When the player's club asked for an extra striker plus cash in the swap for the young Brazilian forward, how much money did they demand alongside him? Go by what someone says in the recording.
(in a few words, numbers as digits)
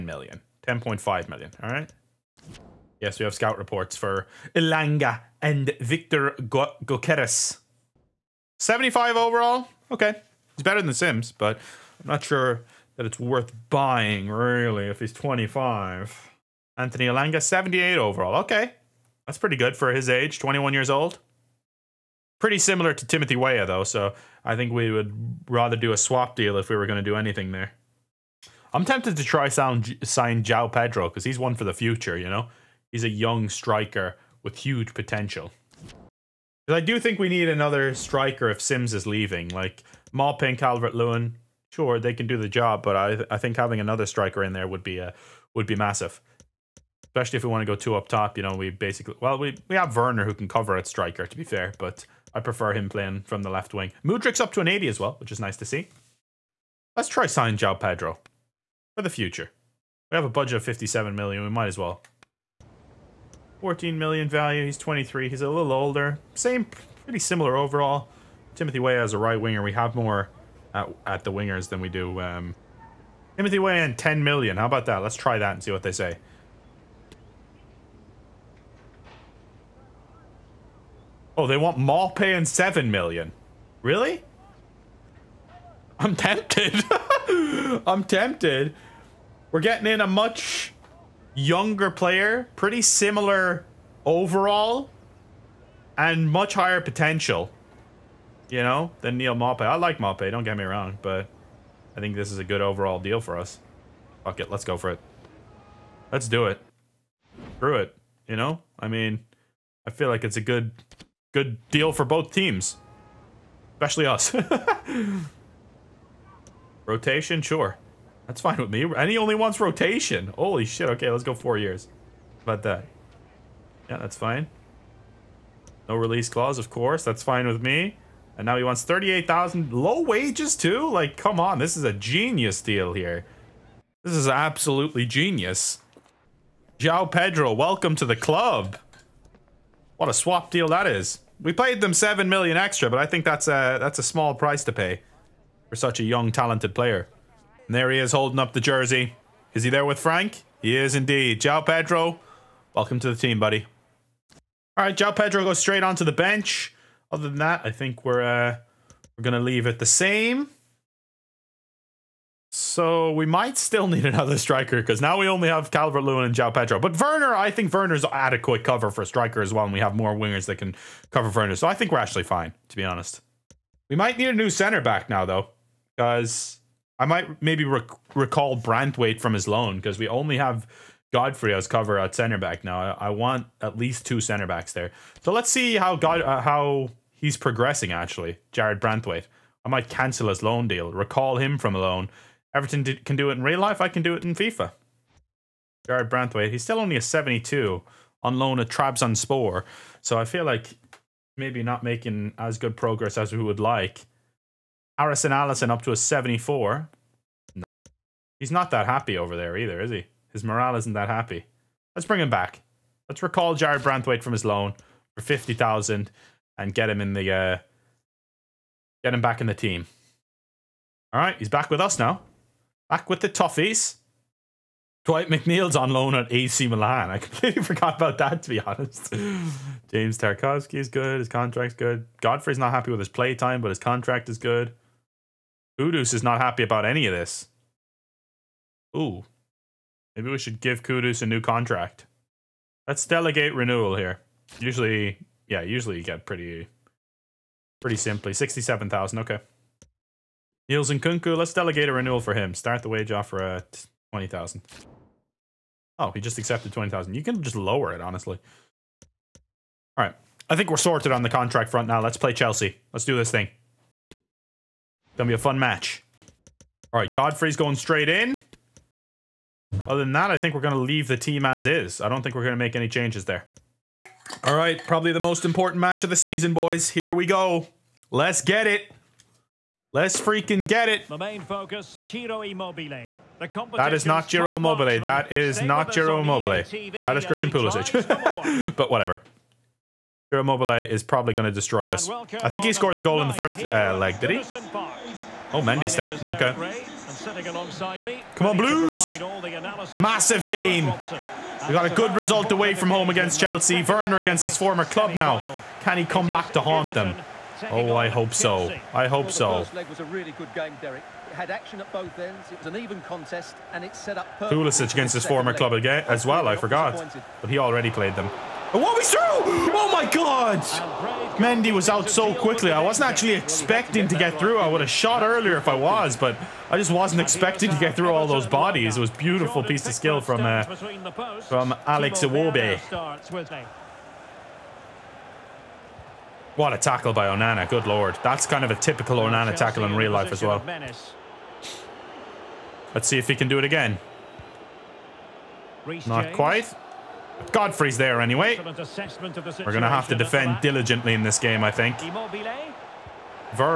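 7 million.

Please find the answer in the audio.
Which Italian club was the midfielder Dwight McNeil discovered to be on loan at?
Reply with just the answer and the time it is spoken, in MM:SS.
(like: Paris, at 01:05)
AC Milan, at 03:46.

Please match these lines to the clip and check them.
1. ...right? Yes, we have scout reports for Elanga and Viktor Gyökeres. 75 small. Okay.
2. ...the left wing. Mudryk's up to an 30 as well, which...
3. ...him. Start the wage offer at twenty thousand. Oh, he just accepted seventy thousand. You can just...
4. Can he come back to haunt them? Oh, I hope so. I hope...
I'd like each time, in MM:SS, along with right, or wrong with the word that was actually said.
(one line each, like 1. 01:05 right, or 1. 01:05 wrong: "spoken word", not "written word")
1. 00:01 wrong: "overall", not "small"
2. 00:53 wrong: "80", not "30"
3. 04:12 wrong: "twenty", not "seventy"
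4. 05:05 right.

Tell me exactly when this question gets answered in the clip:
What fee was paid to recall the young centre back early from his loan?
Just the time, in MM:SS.
03:35.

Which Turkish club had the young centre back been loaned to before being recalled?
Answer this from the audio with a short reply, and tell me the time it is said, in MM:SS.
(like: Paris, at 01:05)
Trabzonspor, at 03:18.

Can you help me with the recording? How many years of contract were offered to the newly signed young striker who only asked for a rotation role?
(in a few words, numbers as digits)
4.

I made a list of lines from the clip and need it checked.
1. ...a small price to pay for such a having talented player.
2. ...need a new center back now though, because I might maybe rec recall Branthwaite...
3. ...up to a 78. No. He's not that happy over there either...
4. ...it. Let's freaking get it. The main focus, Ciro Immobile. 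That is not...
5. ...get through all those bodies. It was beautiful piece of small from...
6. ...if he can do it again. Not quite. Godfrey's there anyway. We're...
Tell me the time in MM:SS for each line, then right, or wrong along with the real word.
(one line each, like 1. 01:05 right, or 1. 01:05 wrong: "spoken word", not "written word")
1. 02:23 wrong: "young", not "having"
2. 02:54 right
3. 03:25 wrong: "74", not "78"
4. 04:38 right
5. 05:27 wrong: "skill", not "small"
6. 05:43 right.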